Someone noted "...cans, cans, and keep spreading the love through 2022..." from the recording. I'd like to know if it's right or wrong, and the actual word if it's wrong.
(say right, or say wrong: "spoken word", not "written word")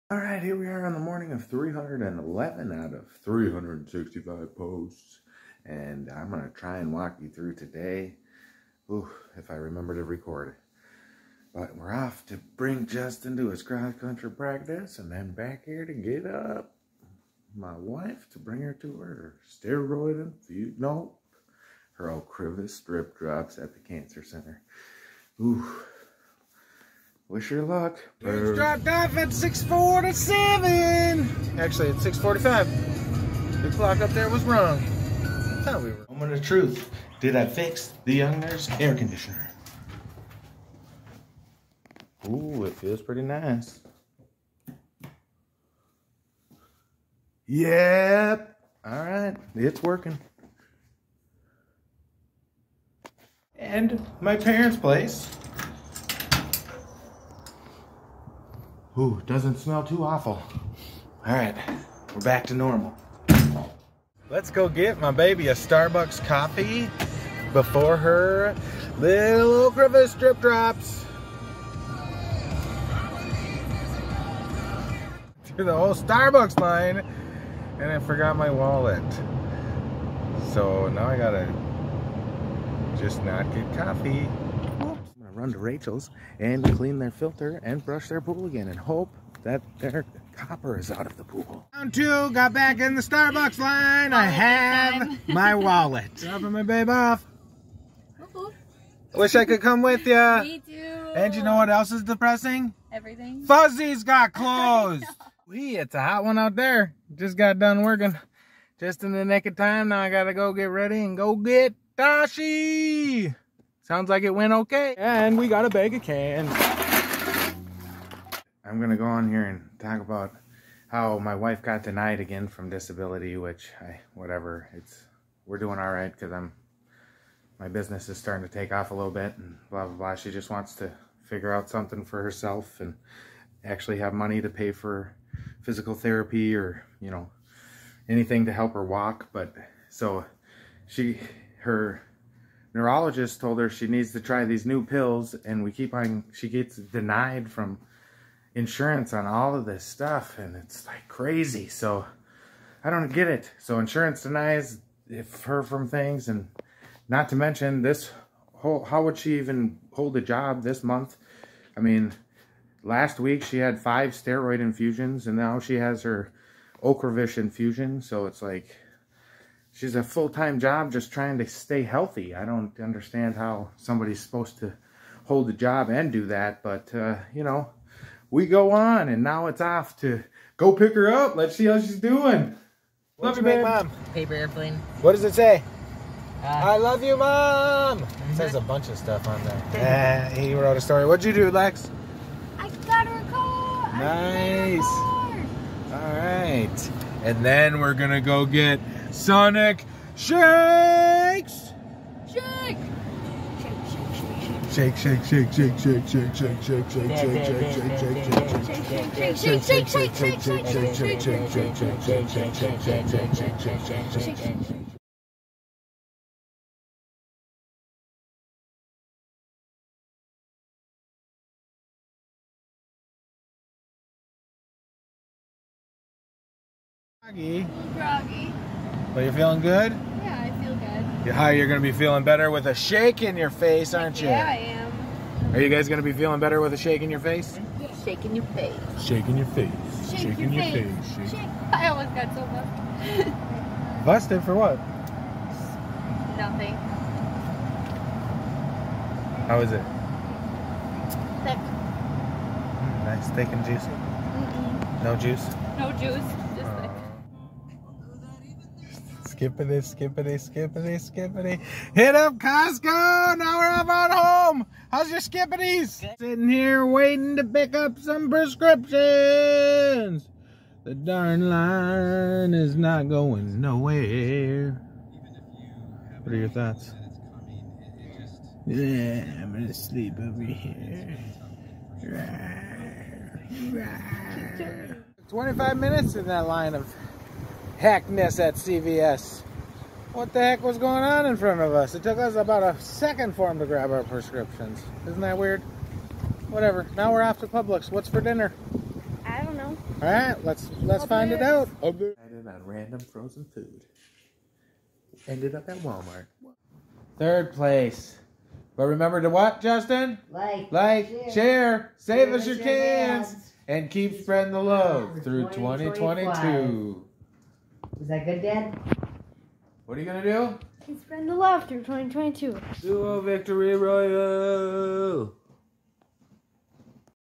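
right.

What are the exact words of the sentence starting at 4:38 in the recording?
Yeah, I'm gonna sleep over here.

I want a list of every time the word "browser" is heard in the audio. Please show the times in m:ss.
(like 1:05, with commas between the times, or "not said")
not said.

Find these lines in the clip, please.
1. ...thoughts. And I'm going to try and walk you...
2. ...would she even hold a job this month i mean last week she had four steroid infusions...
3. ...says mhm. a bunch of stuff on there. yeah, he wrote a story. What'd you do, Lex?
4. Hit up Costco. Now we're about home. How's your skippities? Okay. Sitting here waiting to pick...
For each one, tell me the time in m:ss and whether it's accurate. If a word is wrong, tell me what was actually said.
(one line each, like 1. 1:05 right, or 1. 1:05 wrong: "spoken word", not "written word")
1. 0:04 wrong: "posts", not "thoughts"
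2. 2:39 wrong: "five", not "four"
3. 3:08 right
4. 4:21 right.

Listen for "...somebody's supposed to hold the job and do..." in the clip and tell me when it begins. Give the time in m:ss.
2:53.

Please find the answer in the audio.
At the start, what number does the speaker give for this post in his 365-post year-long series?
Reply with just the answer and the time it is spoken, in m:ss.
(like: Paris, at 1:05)
311, at 0:01.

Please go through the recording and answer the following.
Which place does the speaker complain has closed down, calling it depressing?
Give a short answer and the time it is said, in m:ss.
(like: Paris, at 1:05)
Fuzzy's, at 1:43.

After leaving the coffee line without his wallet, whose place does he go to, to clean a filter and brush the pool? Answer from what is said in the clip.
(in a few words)
Rachel's.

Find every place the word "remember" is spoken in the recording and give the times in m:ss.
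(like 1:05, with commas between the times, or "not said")
0:09, 5:08.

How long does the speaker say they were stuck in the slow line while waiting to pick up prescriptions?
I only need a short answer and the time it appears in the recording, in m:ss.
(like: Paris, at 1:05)
25 minutes, at 4:45.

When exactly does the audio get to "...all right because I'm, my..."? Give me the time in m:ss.
2:05.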